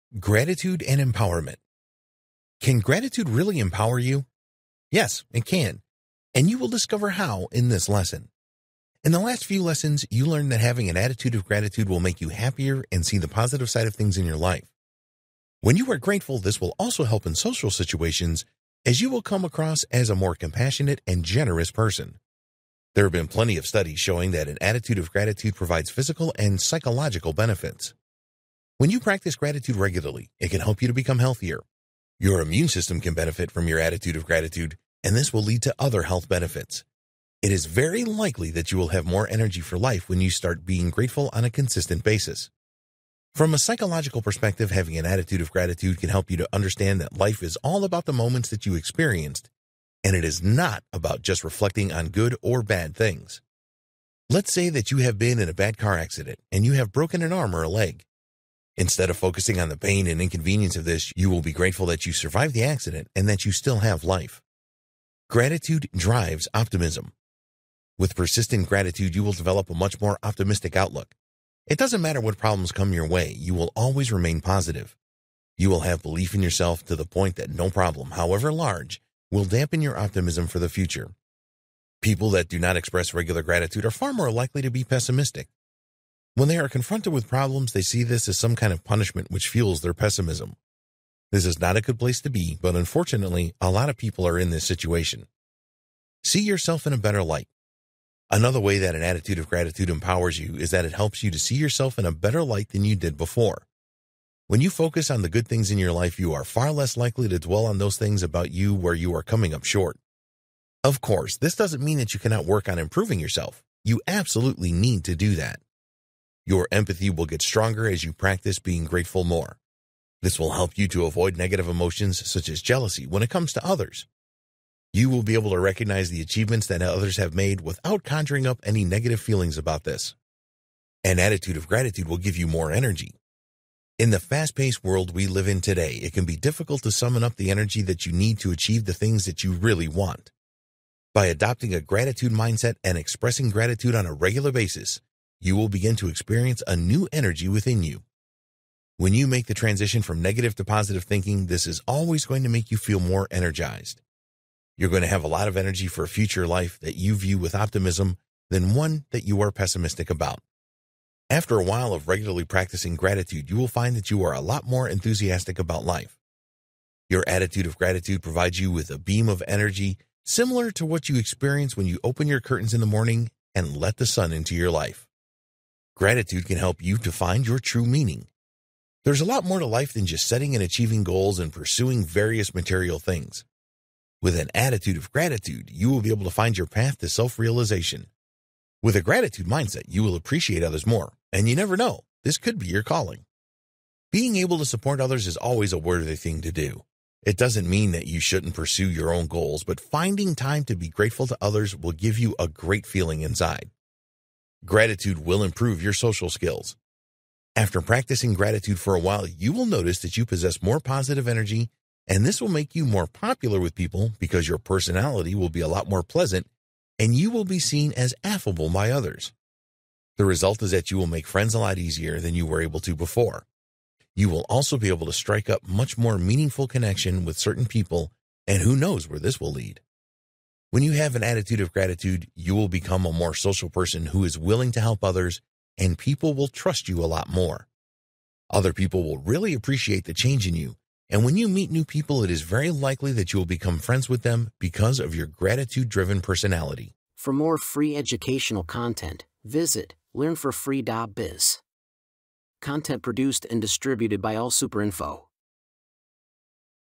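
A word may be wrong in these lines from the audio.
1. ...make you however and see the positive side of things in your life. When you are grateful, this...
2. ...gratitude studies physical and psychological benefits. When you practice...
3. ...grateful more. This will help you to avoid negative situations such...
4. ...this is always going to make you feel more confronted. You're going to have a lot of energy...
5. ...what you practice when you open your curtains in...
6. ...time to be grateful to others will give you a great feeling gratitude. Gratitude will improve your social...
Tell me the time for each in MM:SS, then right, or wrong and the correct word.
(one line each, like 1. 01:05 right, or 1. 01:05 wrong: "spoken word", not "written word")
1. 00:12 wrong: "happier", not "however"
2. 00:25 wrong: "provides", not "studies"
3. 01:58 wrong: "emotions", not "situations"
4. 02:31 wrong: "energized", not "confronted"
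5. 02:50 wrong: "experience", not "practice"
6. 03:20 wrong: "inside", not "gratitude".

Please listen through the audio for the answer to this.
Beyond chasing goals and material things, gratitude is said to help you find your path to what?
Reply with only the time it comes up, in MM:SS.
03:07.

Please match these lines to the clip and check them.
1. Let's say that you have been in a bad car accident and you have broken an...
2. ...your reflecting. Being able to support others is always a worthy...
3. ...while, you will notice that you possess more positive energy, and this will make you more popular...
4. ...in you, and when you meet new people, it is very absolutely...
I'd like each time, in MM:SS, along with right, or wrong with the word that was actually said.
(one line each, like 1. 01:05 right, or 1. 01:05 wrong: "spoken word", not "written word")
1. 00:54 right
2. 03:12 wrong: "calling", not "reflecting"
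3. 03:28 right
4. 04:00 wrong: "likely", not "absolutely".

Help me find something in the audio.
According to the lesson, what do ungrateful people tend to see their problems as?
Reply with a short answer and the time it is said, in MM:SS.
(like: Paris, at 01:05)
punishment, at 01:28.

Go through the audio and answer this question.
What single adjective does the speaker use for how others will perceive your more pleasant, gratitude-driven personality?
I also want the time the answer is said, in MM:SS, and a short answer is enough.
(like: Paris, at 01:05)
affable, at 03:38.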